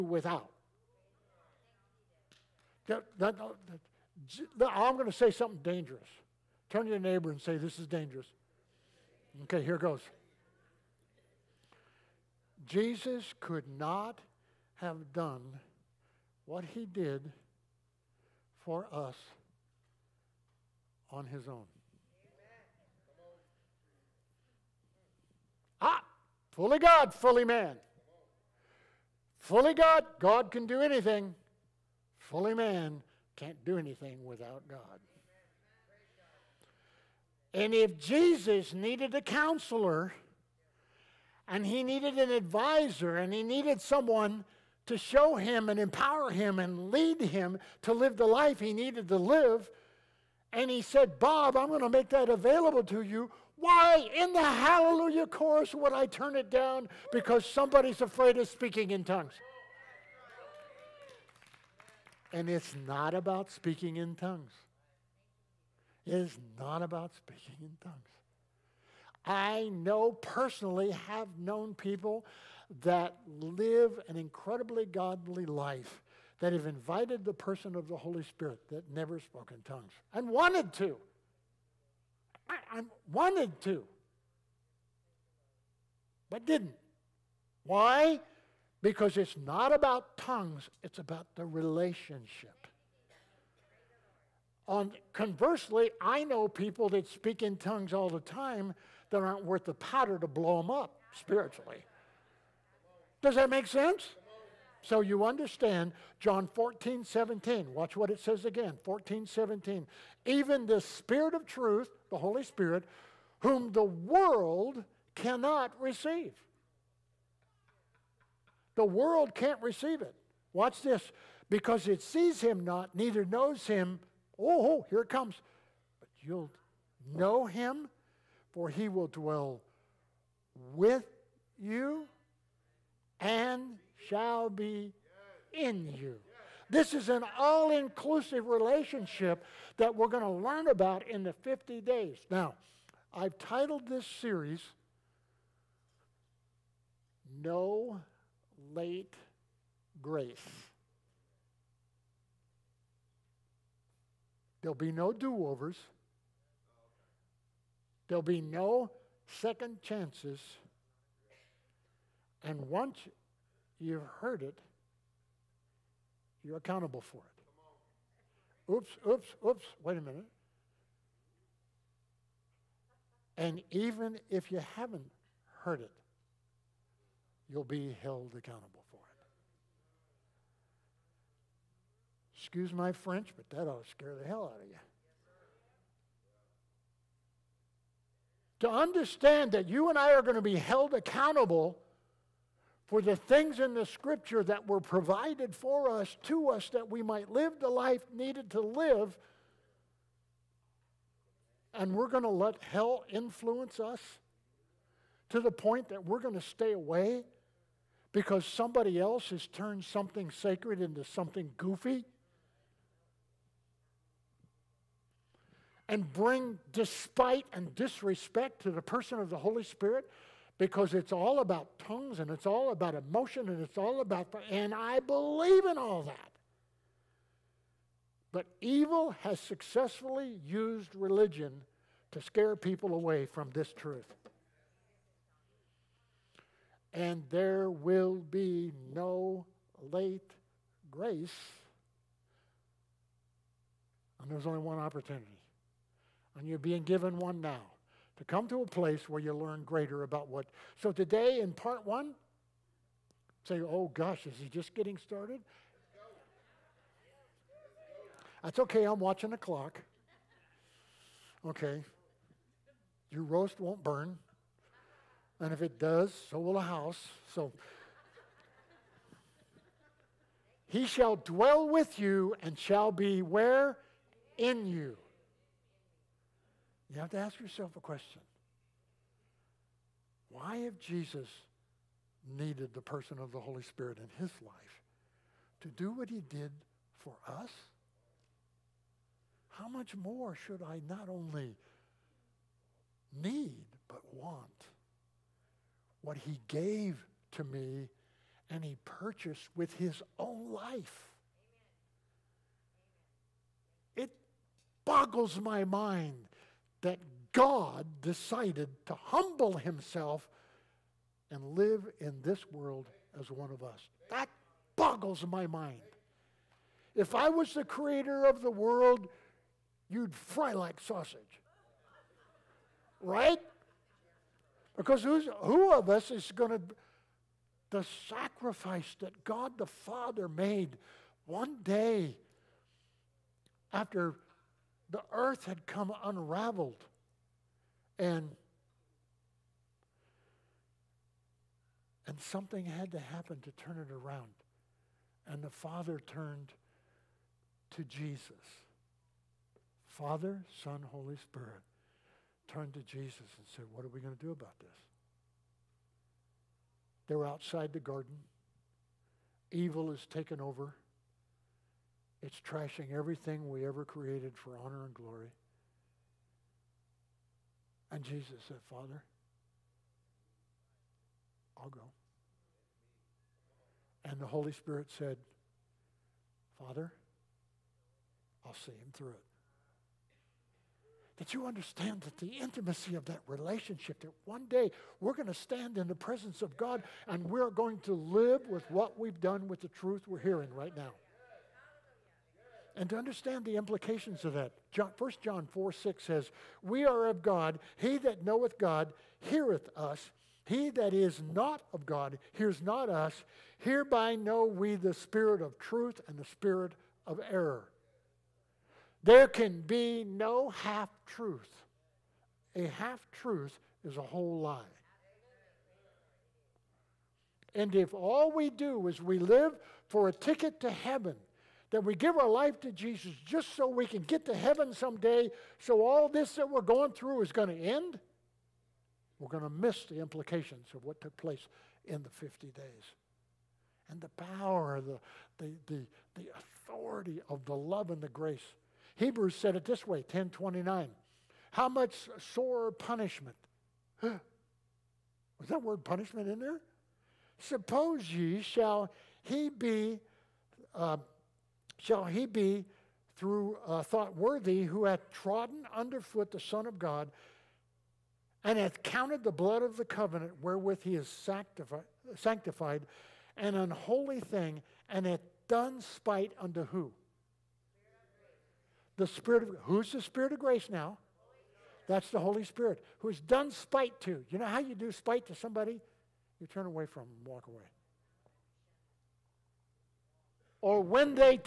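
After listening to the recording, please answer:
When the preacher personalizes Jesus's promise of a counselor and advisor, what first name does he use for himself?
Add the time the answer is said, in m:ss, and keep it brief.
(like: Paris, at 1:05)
Bob, at 0:51.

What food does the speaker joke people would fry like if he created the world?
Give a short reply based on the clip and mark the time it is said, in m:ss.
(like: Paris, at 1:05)
Sausage, at 5:20.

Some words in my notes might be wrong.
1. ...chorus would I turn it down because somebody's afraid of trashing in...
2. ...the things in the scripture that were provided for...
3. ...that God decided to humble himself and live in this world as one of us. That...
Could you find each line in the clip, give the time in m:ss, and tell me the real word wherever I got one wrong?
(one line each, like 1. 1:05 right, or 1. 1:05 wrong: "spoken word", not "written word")
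1. 0:55 wrong: "speaking", not "trashing"
2. 3:13 right
3. 5:06 right.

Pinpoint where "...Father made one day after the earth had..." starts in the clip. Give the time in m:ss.
5:29.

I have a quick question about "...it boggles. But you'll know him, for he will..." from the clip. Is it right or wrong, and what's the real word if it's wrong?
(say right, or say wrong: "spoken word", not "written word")
wrong: "comes", not "boggles".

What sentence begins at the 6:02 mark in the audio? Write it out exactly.
It's trashing everything we ever created for honor and glory.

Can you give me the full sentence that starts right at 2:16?
This is an all inclusive relationship that we're going to learn about in the 50 days.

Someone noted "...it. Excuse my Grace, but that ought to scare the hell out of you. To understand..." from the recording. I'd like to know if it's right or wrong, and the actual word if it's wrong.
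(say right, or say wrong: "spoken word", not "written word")
wrong: "French", not "Grace".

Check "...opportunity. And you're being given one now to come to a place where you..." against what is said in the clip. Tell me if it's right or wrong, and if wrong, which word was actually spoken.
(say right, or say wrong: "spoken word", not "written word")
right.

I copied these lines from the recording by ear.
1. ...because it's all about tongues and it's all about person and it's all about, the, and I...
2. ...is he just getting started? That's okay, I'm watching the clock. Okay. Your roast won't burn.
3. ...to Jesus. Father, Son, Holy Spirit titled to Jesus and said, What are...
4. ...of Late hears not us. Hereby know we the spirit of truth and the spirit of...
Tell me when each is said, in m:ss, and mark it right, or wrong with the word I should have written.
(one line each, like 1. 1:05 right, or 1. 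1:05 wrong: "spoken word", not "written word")
1. 3:40 wrong: "emotion", not "person"
2. 4:14 right
3. 5:47 wrong: "turned", not "titled"
4. 6:41 wrong: "God", not "Late".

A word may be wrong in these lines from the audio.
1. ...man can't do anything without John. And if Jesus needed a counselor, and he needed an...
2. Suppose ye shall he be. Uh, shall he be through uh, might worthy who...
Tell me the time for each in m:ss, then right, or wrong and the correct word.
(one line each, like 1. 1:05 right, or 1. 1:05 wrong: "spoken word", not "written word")
1. 0:32 wrong: "God", not "John"
2. 7:27 wrong: "thought", not "might".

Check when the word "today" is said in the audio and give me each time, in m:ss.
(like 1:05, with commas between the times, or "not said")
4:10.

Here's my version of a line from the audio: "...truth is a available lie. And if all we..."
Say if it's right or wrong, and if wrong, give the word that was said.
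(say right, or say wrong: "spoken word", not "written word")
wrong: "whole", not "available".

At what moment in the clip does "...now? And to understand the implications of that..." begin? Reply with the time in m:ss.
6:30.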